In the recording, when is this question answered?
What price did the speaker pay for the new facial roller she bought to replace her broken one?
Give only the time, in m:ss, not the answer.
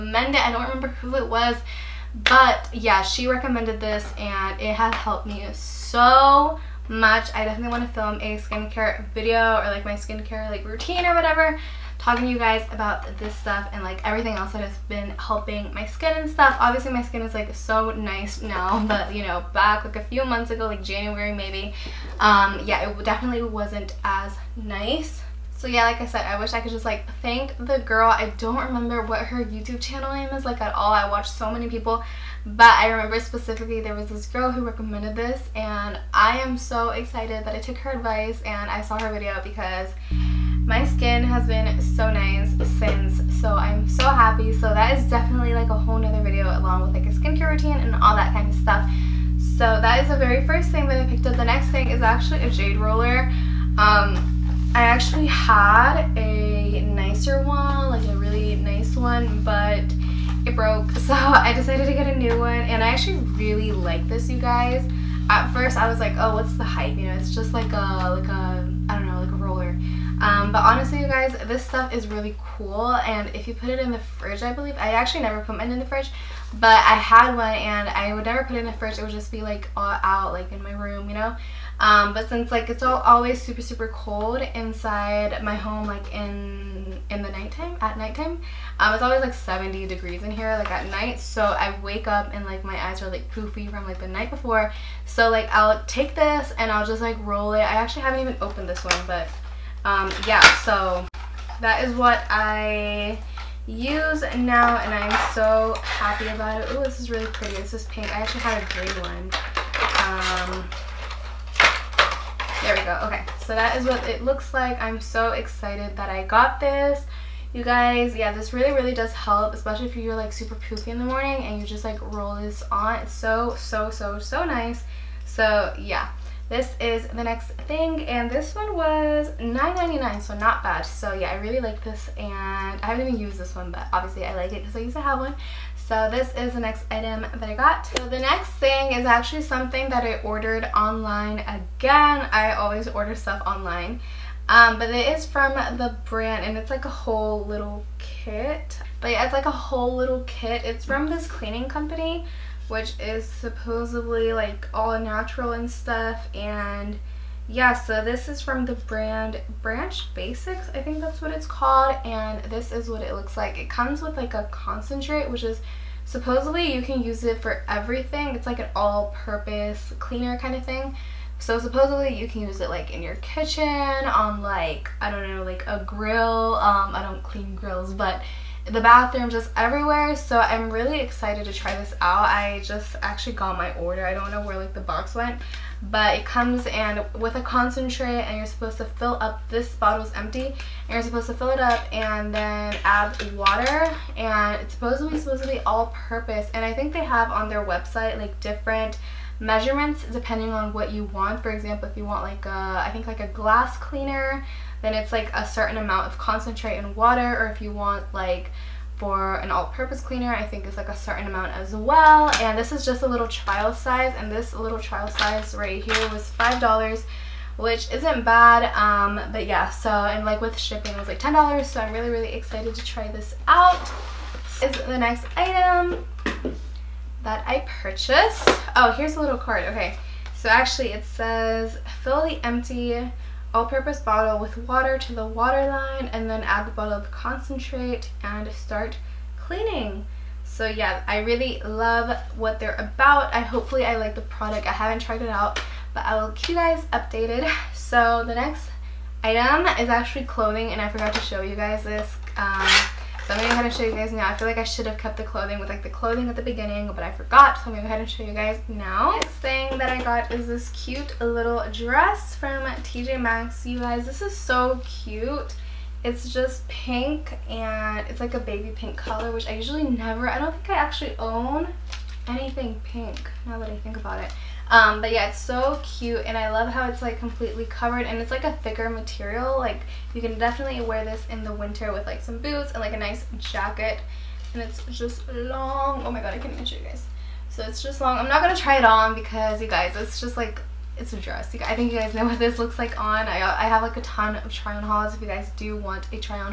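2:09.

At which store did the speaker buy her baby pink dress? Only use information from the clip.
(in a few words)
TJ Maxx.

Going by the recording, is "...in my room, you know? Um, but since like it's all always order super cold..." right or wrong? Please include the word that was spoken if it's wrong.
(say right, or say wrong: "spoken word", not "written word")
wrong: "super", not "order".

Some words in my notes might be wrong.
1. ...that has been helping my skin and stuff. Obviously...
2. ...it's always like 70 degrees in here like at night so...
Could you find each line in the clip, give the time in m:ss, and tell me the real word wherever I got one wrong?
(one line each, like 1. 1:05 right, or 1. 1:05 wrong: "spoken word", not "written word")
1. 0:14 right
2. 1:28 right.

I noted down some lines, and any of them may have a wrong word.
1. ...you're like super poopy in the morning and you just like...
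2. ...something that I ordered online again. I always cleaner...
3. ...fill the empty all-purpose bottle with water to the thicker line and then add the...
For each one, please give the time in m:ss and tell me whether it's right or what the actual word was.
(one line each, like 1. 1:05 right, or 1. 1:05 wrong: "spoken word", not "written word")
1. 1:59 right
2. 2:19 wrong: "order", not "cleaner"
3. 3:52 wrong: "water", not "thicker".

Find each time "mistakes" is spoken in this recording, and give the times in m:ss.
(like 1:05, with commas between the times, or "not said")
not said.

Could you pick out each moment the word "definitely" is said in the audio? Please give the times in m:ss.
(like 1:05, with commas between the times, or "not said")
0:07, 0:23, 0:45, 4:40.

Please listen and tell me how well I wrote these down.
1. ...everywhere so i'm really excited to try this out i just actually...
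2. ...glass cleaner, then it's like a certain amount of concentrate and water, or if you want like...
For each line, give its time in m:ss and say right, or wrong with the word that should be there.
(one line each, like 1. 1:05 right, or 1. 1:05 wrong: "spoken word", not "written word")
1. 2:59 right
2. 3:23 right.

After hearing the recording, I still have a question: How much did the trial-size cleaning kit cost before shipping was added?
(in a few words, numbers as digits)
$5.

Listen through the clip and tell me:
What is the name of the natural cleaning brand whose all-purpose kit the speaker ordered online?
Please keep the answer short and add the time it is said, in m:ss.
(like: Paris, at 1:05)
Branch Basics, at 2:39.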